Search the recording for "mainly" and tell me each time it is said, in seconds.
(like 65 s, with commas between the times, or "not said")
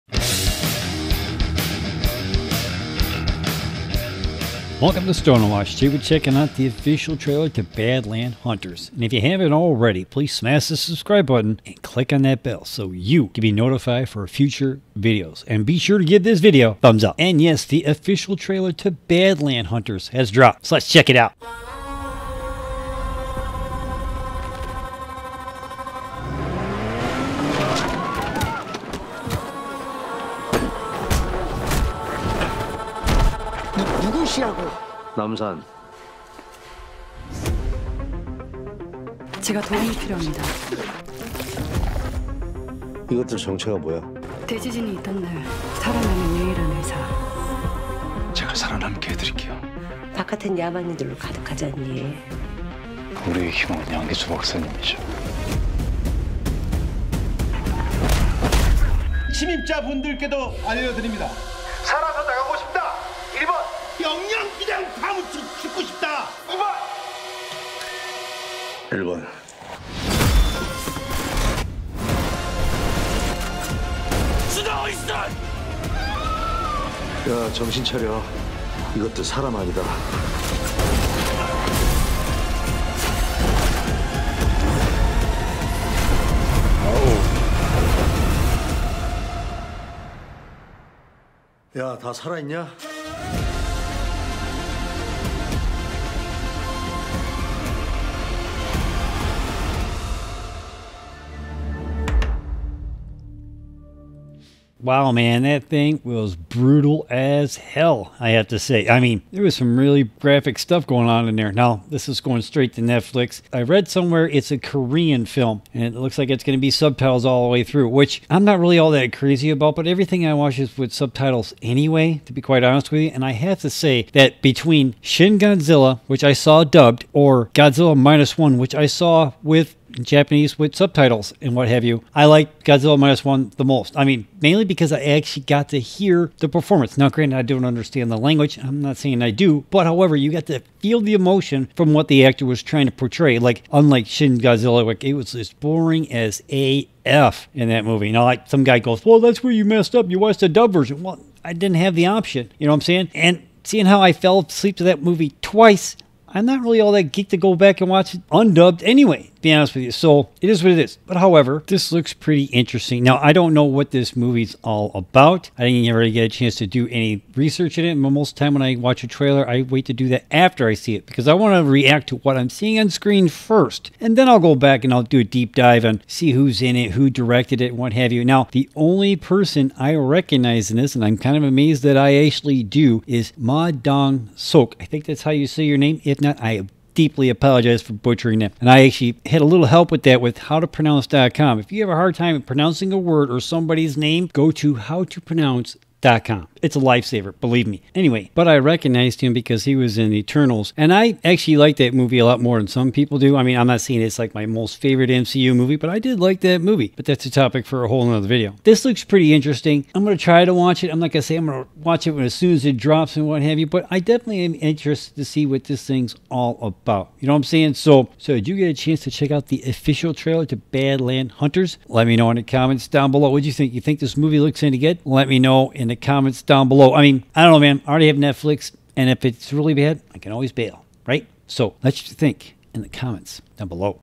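134 s.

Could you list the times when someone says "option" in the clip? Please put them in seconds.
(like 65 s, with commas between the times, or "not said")
152 s.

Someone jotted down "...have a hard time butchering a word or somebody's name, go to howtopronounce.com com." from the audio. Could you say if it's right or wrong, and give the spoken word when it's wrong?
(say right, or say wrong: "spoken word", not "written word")
wrong: "pronouncing", not "butchering".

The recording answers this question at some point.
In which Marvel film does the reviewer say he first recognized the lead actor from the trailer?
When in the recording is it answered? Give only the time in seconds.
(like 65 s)
200 s.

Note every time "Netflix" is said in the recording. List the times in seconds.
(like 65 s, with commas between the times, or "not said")
112 s, 228 s.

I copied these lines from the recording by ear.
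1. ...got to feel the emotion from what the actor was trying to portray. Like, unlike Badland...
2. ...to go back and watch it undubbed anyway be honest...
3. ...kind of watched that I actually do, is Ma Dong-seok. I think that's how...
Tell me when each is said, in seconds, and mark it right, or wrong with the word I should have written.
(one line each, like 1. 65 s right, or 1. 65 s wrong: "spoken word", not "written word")
1. 140 s wrong: "Shin", not "Badland"
2. 157 s right
3. 181 s wrong: "amazed", not "watched".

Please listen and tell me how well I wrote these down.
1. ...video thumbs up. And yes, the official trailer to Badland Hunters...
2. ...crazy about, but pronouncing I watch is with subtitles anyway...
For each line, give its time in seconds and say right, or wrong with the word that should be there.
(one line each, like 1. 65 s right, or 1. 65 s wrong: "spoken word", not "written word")
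1. 16 s right
2. 119 s wrong: "everything", not "pronouncing".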